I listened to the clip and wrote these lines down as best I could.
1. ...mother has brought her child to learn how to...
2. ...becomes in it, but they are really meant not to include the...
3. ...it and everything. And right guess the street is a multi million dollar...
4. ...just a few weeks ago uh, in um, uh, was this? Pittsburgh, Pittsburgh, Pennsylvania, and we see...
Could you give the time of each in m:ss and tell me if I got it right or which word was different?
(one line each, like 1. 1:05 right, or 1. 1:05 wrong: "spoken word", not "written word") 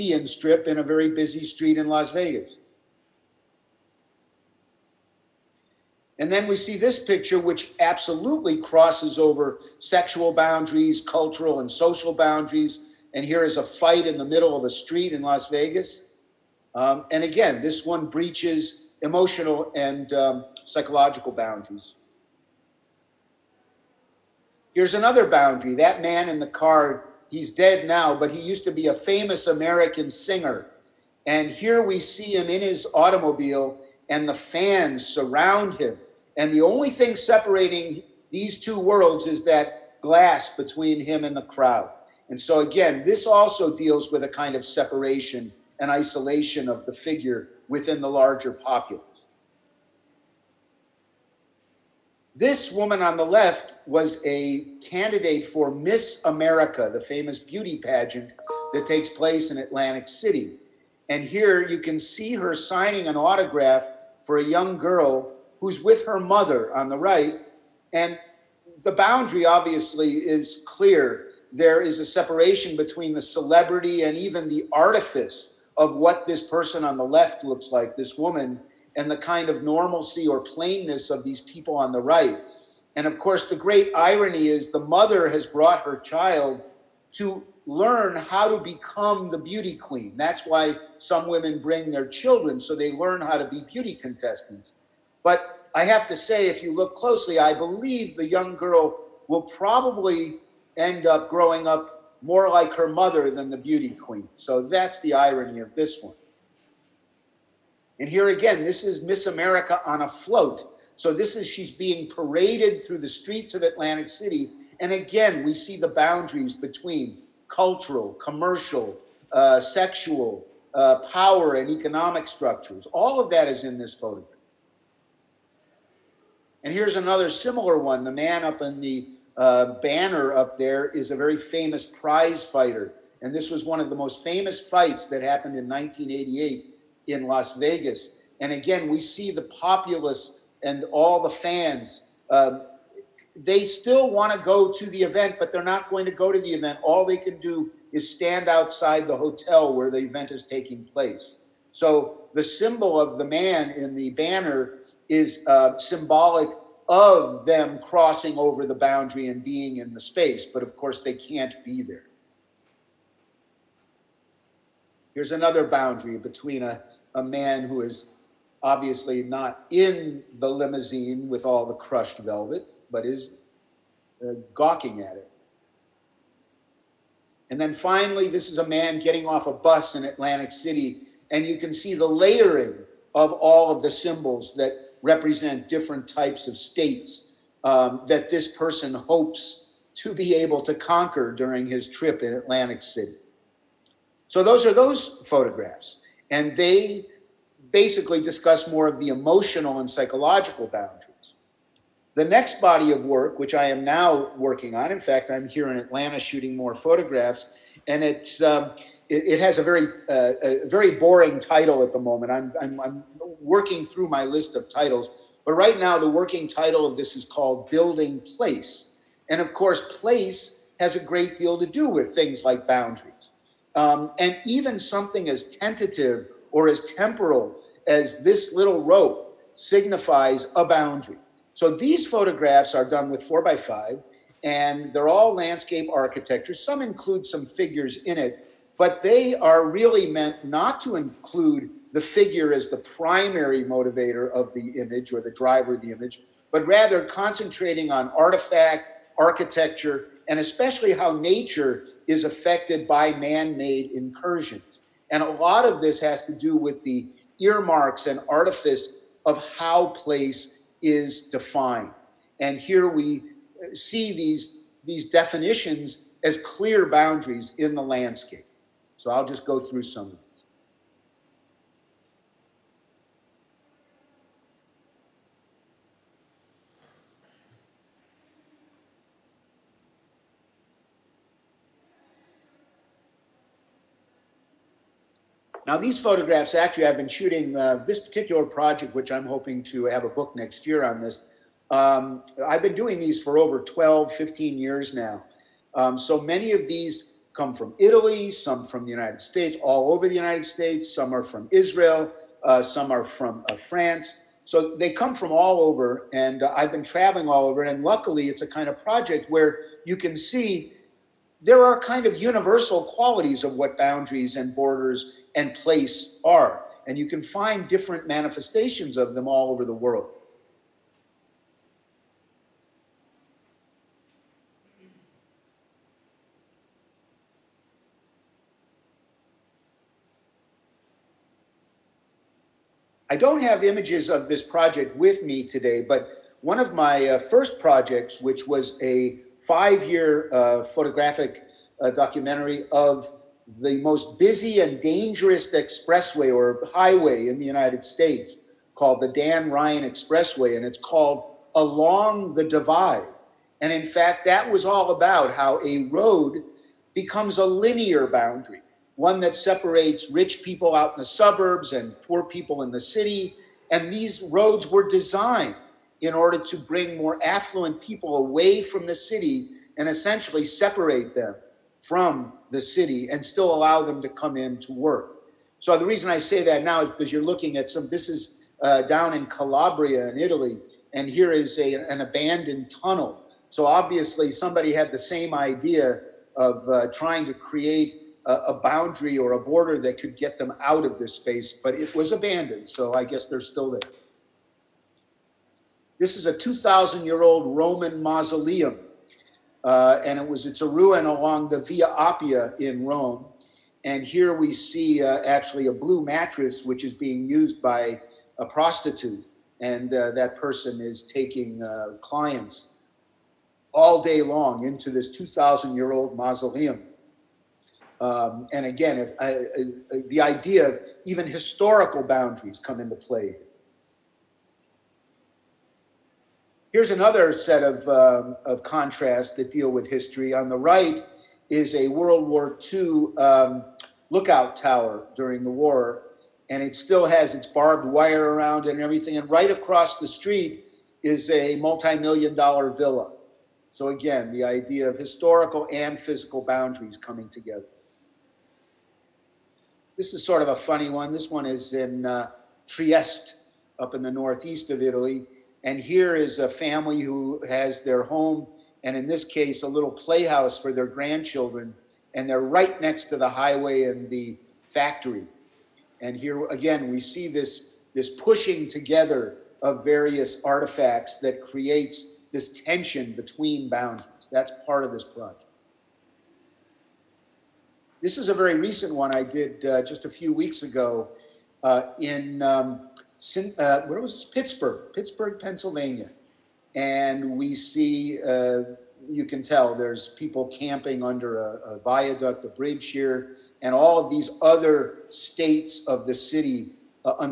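1. 1:24 right
2. 3:57 wrong: "figures", not "becomes"
3. 7:18 wrong: "across", not "guess"
4. 7:59 right.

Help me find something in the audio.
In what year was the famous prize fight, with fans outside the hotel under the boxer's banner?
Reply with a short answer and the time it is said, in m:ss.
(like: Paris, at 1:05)
1988, at 2:15.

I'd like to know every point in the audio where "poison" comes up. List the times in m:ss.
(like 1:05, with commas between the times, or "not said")
not said.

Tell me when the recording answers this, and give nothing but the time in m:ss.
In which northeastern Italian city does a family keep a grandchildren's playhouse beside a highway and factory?
7:32.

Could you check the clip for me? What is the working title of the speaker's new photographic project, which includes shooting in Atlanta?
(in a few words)
Building Place.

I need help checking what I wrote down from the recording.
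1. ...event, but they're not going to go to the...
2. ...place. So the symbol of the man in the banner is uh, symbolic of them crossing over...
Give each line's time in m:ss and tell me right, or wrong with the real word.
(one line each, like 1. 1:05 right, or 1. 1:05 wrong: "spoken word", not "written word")
1. 2:25 right
2. 2:30 right.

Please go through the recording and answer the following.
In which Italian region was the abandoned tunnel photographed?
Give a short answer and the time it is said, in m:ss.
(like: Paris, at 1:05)
Calabria, at 6:19.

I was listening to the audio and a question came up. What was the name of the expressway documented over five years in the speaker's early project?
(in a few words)
Dan Ryan Expressway.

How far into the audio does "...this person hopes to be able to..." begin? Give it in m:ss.
3:08.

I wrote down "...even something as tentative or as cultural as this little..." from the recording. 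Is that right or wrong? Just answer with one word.
wrong.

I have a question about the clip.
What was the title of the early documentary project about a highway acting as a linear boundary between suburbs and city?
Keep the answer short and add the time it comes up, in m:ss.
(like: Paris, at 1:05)
Along the Divide, at 5:51.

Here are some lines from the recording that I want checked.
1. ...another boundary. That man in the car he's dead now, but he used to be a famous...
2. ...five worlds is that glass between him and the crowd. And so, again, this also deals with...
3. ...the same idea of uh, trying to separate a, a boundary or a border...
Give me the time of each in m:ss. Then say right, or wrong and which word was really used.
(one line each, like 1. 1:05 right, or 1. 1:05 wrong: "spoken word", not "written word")
1. 0:24 right
2. 0:38 wrong: "two", not "five"
3. 6:24 wrong: "create", not "separate".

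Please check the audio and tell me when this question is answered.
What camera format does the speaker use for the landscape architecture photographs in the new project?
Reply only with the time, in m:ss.
3:53.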